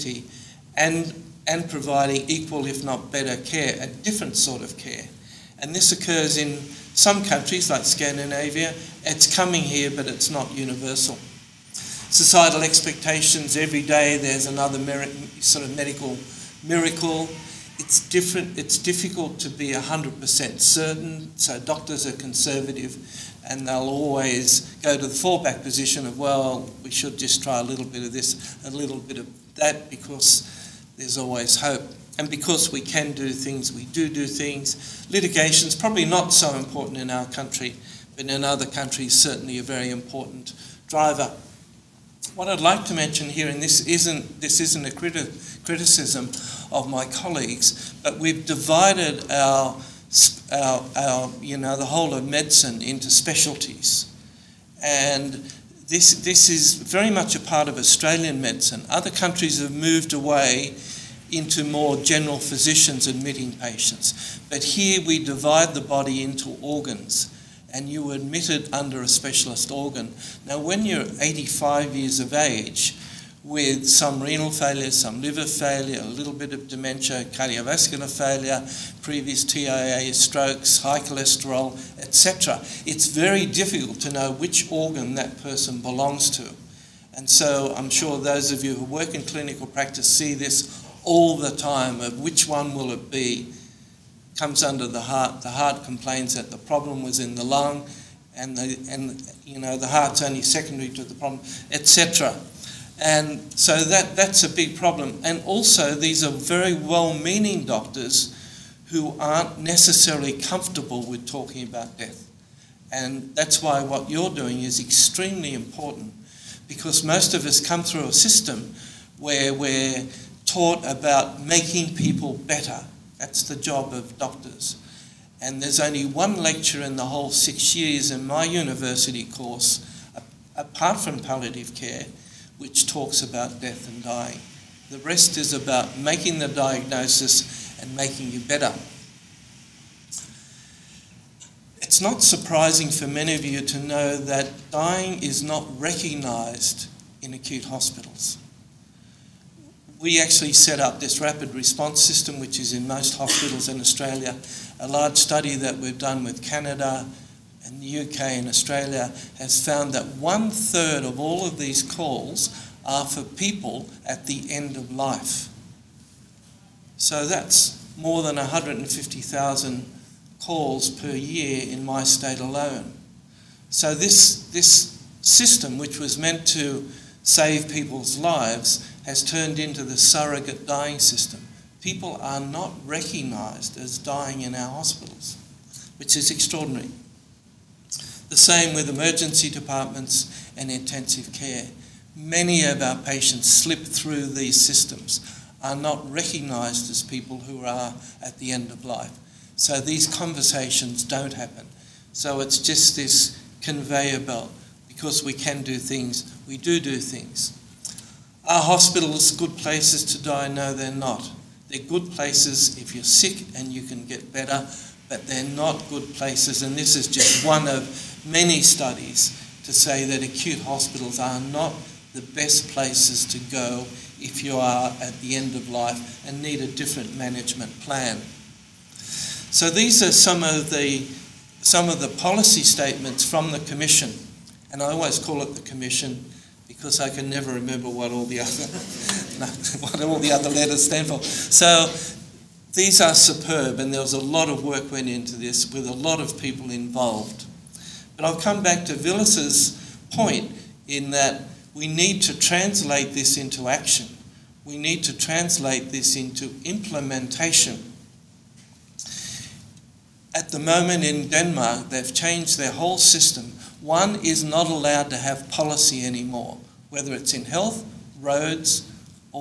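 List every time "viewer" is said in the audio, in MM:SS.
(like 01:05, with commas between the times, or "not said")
not said.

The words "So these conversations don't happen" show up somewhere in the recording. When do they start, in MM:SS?
03:19.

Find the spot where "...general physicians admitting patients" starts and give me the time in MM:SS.
01:01.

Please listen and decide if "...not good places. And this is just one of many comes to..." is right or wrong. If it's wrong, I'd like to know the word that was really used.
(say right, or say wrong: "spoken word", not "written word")
wrong: "studies", not "comes".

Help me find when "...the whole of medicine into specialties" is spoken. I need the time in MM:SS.
00:51.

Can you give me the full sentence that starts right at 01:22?
It's very difficult to know which organ that person belongs to.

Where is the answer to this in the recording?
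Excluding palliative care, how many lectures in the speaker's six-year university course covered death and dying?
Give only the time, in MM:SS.
02:06.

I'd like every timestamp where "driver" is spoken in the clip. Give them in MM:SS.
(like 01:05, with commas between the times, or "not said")
00:40.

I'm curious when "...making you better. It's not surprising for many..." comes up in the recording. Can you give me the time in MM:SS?
02:17.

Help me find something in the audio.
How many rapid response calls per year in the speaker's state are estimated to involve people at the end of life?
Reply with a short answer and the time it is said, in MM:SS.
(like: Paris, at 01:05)
150,000, at 02:48.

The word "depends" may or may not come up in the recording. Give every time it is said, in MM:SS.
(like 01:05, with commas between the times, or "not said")
not said.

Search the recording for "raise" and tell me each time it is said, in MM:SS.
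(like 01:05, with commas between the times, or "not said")
not said.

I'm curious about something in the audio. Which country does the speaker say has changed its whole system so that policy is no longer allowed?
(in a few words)
Denmark.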